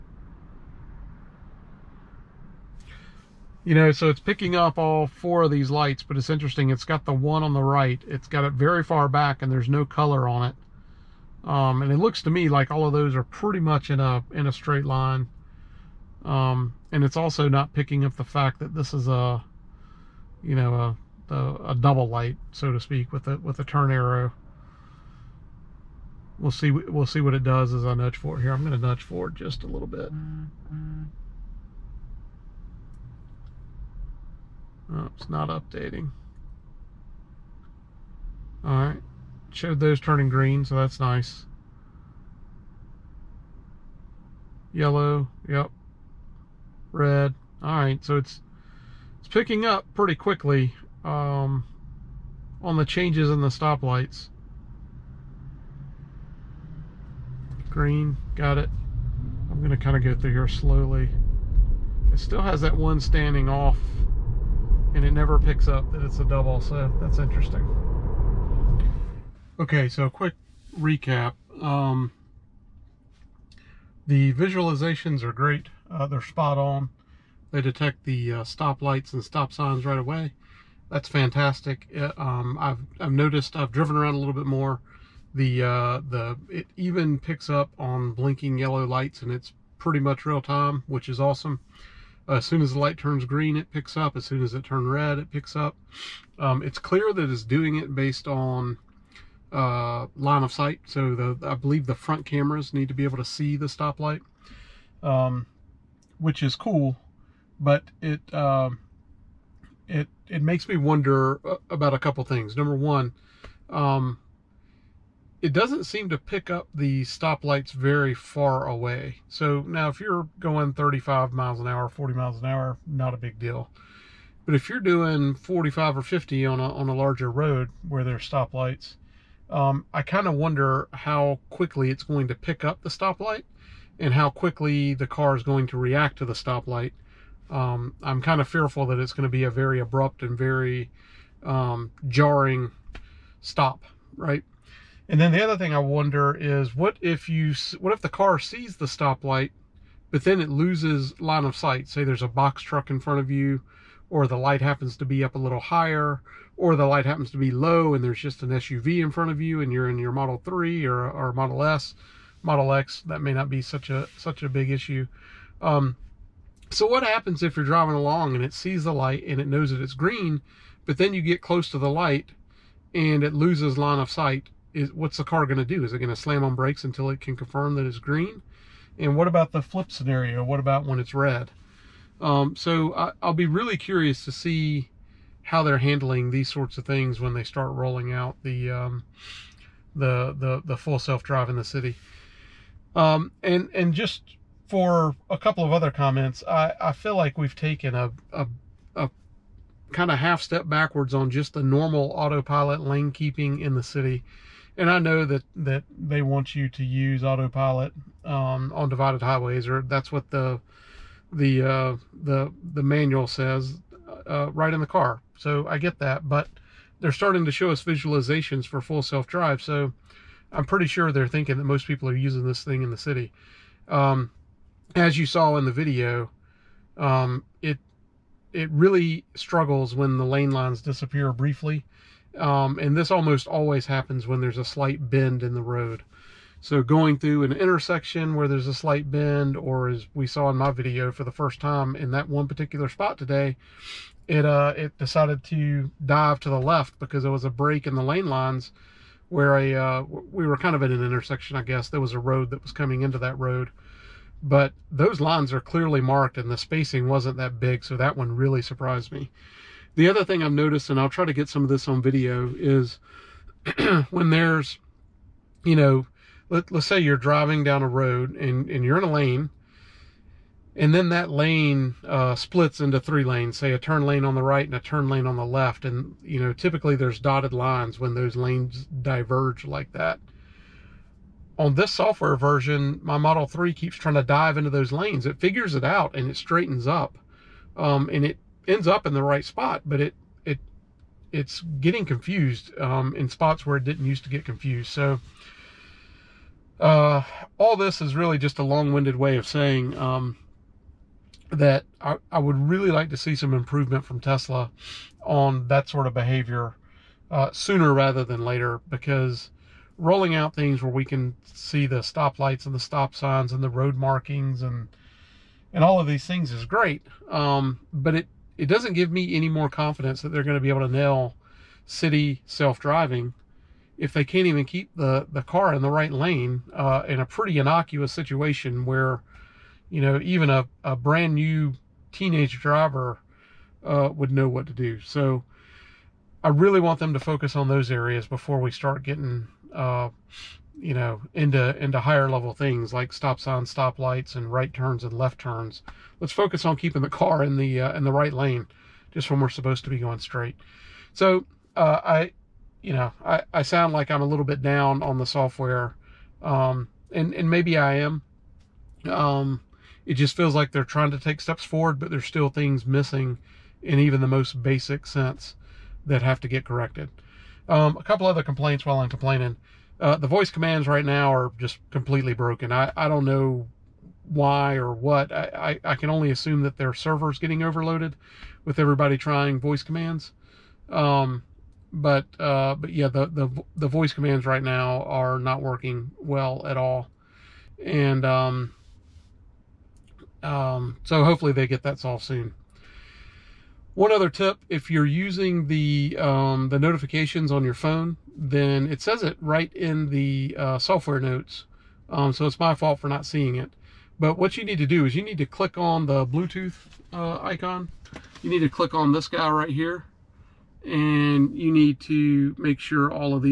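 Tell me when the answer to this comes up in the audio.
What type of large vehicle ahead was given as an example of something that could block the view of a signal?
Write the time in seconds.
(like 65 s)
152 s.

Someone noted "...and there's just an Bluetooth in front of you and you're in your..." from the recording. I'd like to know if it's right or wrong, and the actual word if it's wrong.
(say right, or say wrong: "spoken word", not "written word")
wrong: "SUV", not "Bluetooth".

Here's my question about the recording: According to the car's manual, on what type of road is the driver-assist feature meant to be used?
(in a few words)
divided highways.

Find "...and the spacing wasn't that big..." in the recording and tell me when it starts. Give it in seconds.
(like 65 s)
256 s.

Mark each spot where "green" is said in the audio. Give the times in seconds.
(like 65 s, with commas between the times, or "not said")
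40 s, 57 s, 93 s, 169 s, 177 s.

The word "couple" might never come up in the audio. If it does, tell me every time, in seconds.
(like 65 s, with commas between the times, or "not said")
111 s, 195 s, 368 s.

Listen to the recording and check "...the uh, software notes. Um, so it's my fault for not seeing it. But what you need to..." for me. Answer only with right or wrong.
right.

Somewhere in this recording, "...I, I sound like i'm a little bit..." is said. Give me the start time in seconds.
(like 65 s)
353 s.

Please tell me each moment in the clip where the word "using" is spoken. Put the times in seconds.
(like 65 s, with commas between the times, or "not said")
222 s, 395 s.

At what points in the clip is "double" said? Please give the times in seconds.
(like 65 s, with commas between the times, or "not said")
21 s, 66 s.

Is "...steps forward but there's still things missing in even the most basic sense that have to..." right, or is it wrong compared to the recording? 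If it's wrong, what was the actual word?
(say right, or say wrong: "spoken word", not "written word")
right.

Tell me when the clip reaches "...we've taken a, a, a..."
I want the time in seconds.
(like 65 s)
197 s.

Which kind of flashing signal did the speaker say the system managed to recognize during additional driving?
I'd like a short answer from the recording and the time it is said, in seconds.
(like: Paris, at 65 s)
blinking yellow lights, at 88 s.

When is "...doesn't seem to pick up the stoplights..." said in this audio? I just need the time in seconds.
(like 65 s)
115 s.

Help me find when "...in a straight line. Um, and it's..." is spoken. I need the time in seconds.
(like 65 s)
14 s.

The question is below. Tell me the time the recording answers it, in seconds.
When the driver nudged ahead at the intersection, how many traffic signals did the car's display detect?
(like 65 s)
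5 s.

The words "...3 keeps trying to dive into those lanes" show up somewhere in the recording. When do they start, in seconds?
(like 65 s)
283 s.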